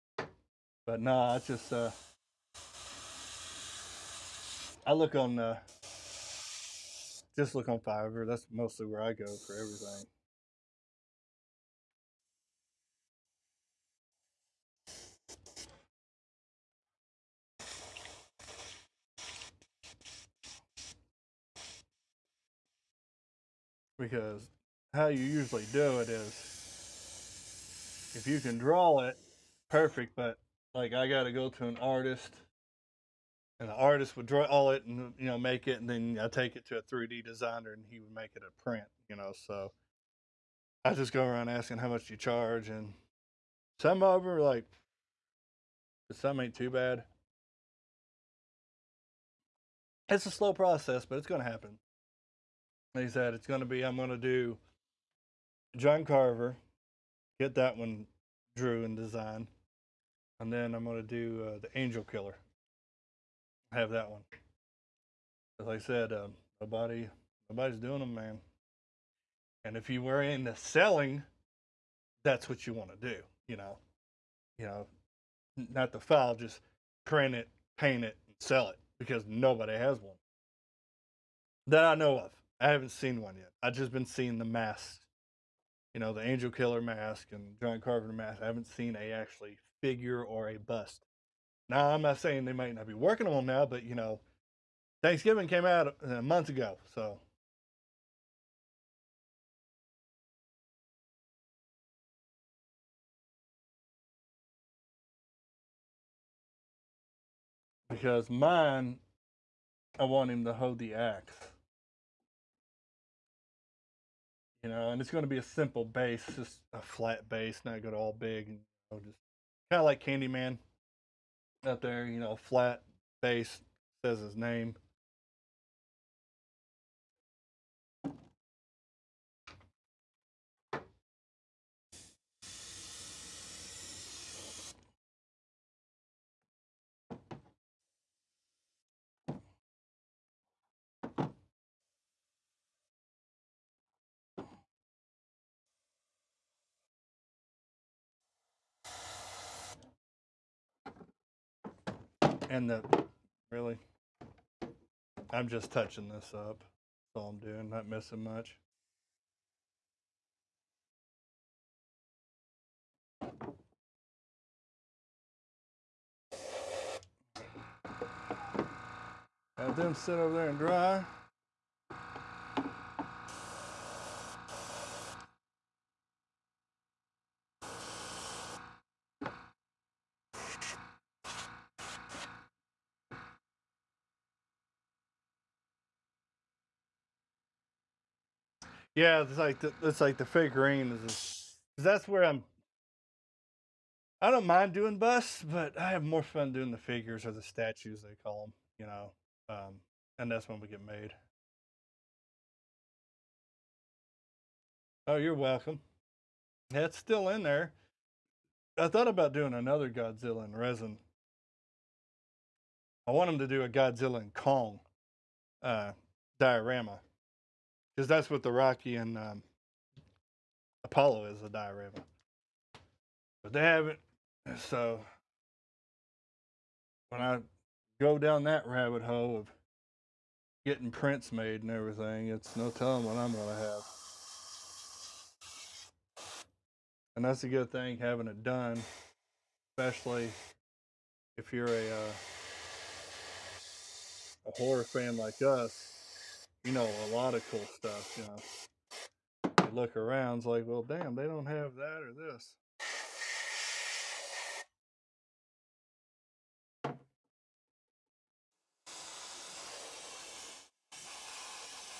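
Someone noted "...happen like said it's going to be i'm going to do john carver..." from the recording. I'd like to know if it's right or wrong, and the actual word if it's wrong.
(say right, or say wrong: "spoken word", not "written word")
right.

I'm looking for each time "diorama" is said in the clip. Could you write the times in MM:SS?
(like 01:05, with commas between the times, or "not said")
03:36, 03:41.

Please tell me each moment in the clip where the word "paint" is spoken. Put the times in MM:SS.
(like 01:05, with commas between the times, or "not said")
01:17.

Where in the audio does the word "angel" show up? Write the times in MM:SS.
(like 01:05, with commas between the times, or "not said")
01:01, 01:26.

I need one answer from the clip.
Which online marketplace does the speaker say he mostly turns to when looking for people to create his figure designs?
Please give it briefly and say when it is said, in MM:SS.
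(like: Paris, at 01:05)
Fiverr, at 00:07.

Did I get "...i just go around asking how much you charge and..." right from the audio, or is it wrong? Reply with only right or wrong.
right.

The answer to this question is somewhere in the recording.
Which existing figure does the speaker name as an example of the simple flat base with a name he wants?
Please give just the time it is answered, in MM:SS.
02:00.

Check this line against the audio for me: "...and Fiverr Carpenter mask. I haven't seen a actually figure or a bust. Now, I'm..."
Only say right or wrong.
wrong.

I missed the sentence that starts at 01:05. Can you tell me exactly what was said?
As I said, um, uh, nobody, nobody's doing them, man.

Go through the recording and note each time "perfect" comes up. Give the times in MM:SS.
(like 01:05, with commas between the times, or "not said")
00:29.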